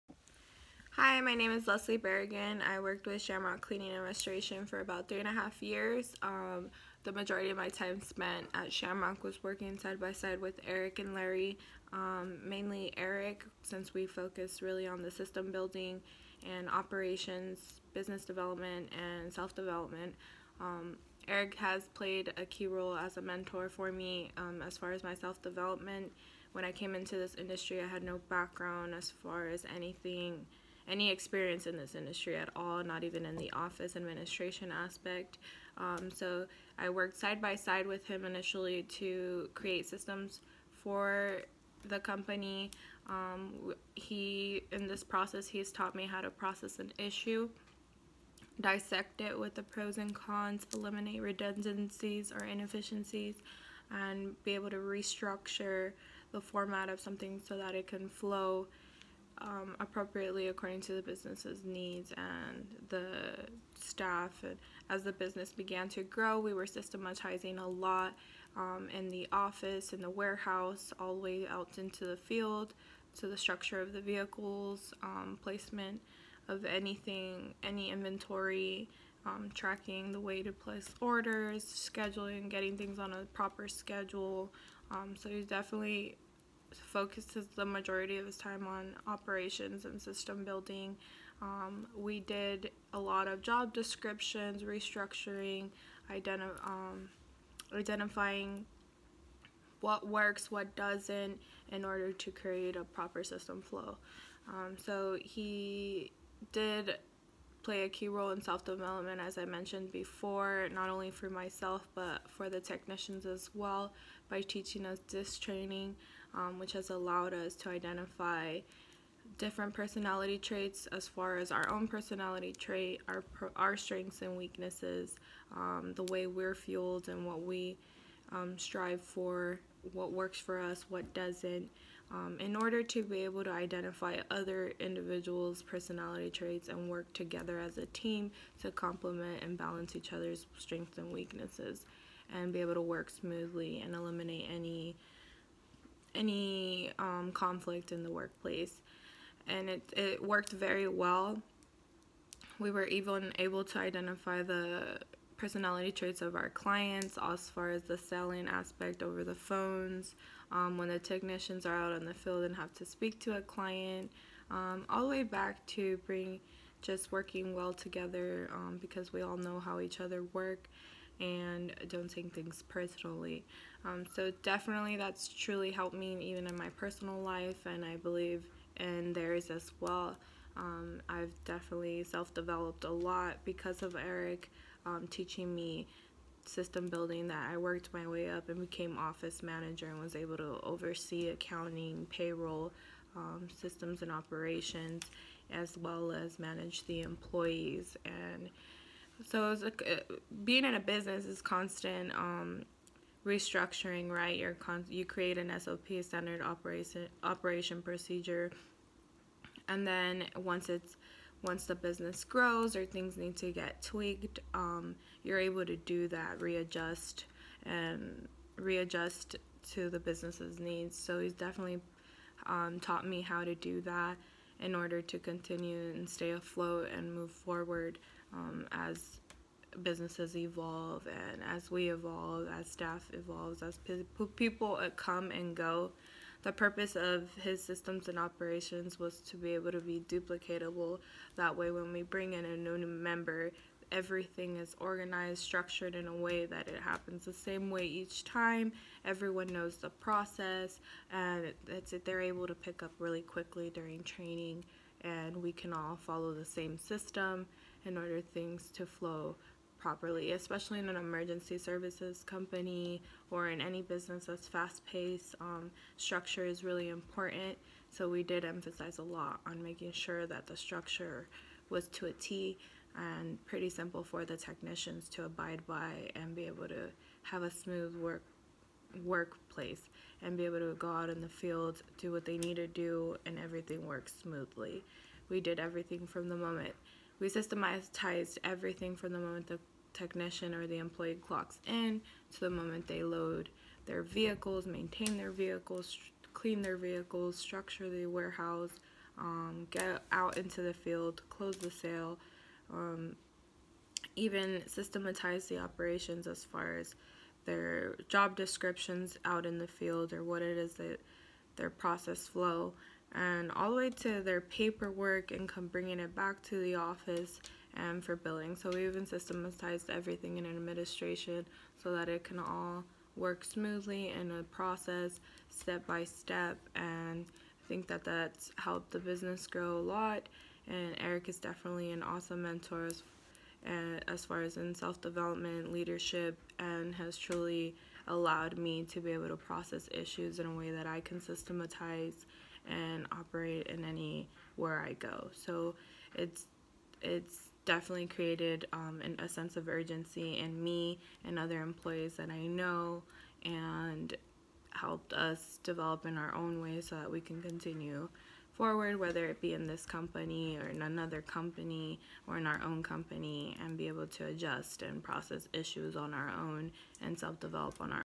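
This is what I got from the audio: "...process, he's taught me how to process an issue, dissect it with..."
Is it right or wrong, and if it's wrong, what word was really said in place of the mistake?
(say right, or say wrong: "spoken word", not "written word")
right.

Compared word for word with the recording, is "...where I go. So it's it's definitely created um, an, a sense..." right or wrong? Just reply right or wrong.
right.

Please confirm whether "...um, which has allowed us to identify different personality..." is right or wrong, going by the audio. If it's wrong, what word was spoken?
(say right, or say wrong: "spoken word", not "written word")
right.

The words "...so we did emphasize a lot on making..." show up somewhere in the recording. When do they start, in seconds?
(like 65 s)
267 s.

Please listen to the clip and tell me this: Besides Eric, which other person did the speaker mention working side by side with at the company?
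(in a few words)
Larry.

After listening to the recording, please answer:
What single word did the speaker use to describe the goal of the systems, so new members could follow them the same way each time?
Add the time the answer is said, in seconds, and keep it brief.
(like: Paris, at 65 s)
Duplicatable, at 240 s.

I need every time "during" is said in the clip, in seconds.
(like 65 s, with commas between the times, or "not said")
253 s.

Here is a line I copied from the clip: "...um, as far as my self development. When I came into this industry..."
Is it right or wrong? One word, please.
right.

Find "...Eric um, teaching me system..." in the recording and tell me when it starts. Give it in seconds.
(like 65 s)
183 s.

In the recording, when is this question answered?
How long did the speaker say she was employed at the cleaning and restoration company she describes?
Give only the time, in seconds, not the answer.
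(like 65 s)
5 s.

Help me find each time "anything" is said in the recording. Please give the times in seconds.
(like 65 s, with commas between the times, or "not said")
29 s, 76 s.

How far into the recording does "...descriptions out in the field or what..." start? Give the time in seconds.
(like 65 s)
308 s.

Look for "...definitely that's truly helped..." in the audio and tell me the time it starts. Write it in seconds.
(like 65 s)
174 s.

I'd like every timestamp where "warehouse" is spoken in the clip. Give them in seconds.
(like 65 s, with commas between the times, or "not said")
70 s, 298 s.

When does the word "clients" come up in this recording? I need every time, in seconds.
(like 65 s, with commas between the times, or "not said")
156 s, 163 s.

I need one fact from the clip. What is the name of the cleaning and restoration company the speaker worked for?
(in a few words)
Shamrock Cleaning and Restoration.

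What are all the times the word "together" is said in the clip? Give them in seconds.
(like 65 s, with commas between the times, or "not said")
137 s, 167 s.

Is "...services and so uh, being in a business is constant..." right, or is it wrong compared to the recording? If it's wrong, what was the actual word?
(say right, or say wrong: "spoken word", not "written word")
wrong: "employees", not "services".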